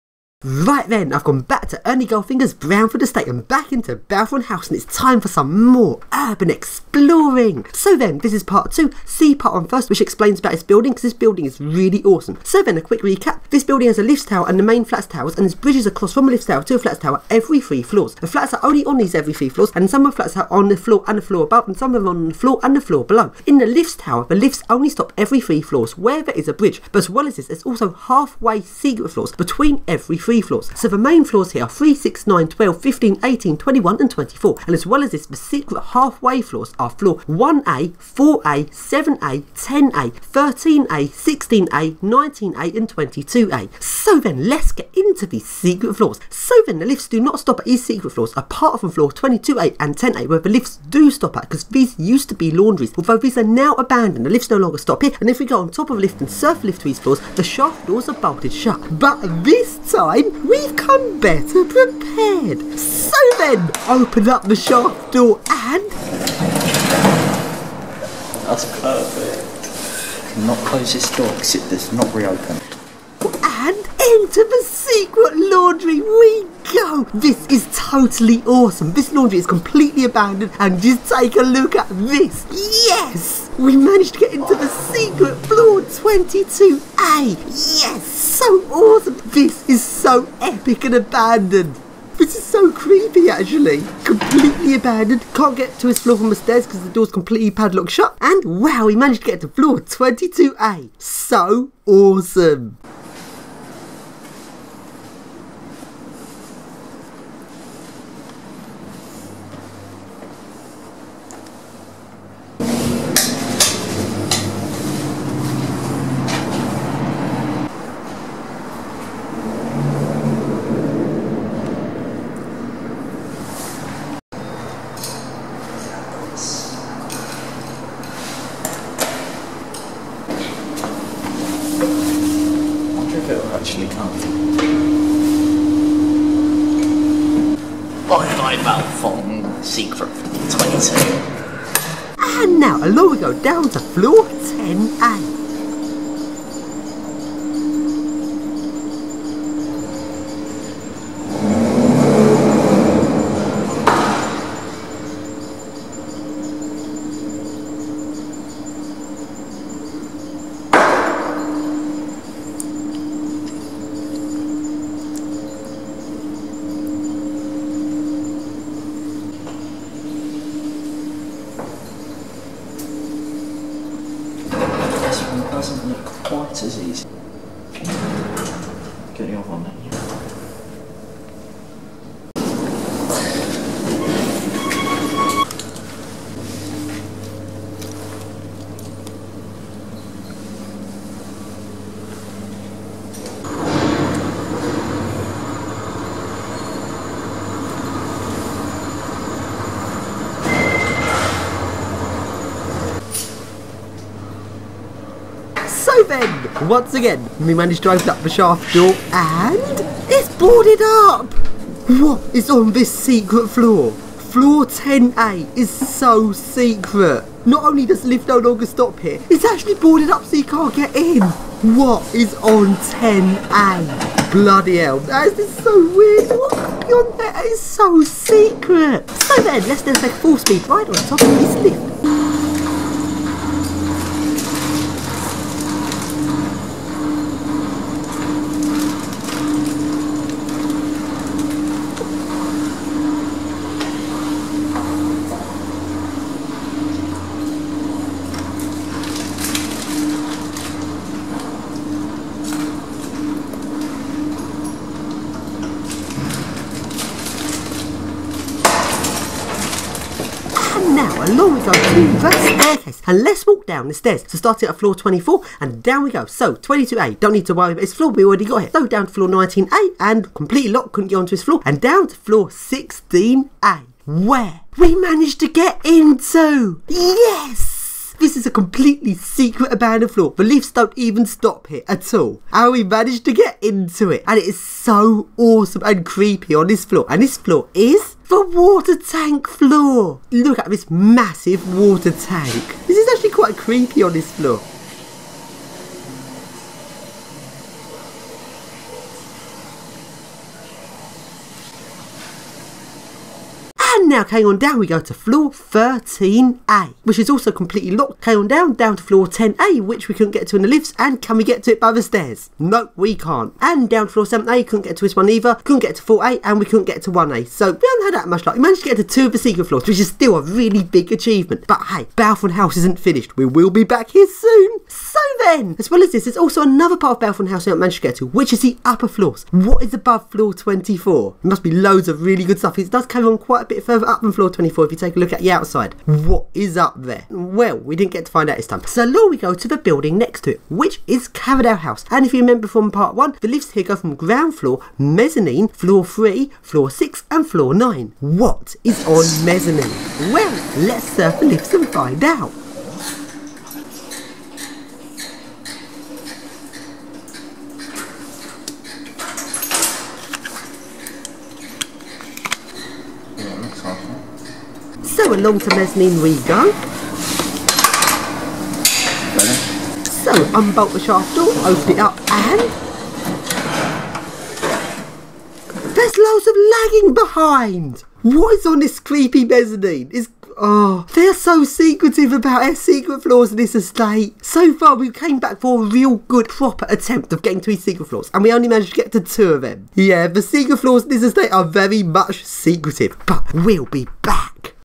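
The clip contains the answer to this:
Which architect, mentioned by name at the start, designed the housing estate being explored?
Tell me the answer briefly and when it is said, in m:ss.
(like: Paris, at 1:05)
Ernie Goldfinger, at 0:01.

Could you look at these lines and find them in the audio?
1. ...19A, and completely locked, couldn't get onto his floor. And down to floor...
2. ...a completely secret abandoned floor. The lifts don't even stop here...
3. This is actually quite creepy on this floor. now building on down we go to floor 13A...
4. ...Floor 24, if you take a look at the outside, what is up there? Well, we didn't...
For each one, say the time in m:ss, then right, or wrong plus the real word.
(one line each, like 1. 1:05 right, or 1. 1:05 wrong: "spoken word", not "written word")
1. 4:29 right
2. 4:38 right
3. 4:52 wrong: "carrying", not "building"
4. 5:34 right.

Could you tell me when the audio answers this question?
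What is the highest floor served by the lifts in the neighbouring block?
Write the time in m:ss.
5:47.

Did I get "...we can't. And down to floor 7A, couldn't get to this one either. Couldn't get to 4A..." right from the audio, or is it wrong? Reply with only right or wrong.
right.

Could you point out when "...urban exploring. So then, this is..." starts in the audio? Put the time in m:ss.
0:06.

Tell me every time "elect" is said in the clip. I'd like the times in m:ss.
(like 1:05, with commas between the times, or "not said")
not said.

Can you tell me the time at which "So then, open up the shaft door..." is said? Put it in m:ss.
1:02.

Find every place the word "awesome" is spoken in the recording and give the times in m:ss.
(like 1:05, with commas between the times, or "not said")
0:12, 1:18, 1:28, 1:41, 4:45.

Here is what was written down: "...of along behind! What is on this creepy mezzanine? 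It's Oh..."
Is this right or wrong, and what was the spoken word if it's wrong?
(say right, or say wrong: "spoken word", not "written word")
wrong: "lagging", not "along".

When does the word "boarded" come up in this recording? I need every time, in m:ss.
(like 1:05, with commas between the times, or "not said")
3:30, 3:39.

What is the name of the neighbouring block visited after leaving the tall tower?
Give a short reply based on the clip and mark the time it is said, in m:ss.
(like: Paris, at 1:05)
Carradale House, at 5:41.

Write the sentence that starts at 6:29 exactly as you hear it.
Yeah, the secret floors in this estate are very much secretive, but we'll be back.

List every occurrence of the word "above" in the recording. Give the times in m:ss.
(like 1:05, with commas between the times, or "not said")
0:21, 5:29.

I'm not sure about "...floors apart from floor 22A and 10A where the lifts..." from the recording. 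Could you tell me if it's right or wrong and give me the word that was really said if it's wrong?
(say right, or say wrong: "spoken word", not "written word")
right.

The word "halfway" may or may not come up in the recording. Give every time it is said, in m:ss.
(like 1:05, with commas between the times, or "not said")
0:27, 0:35.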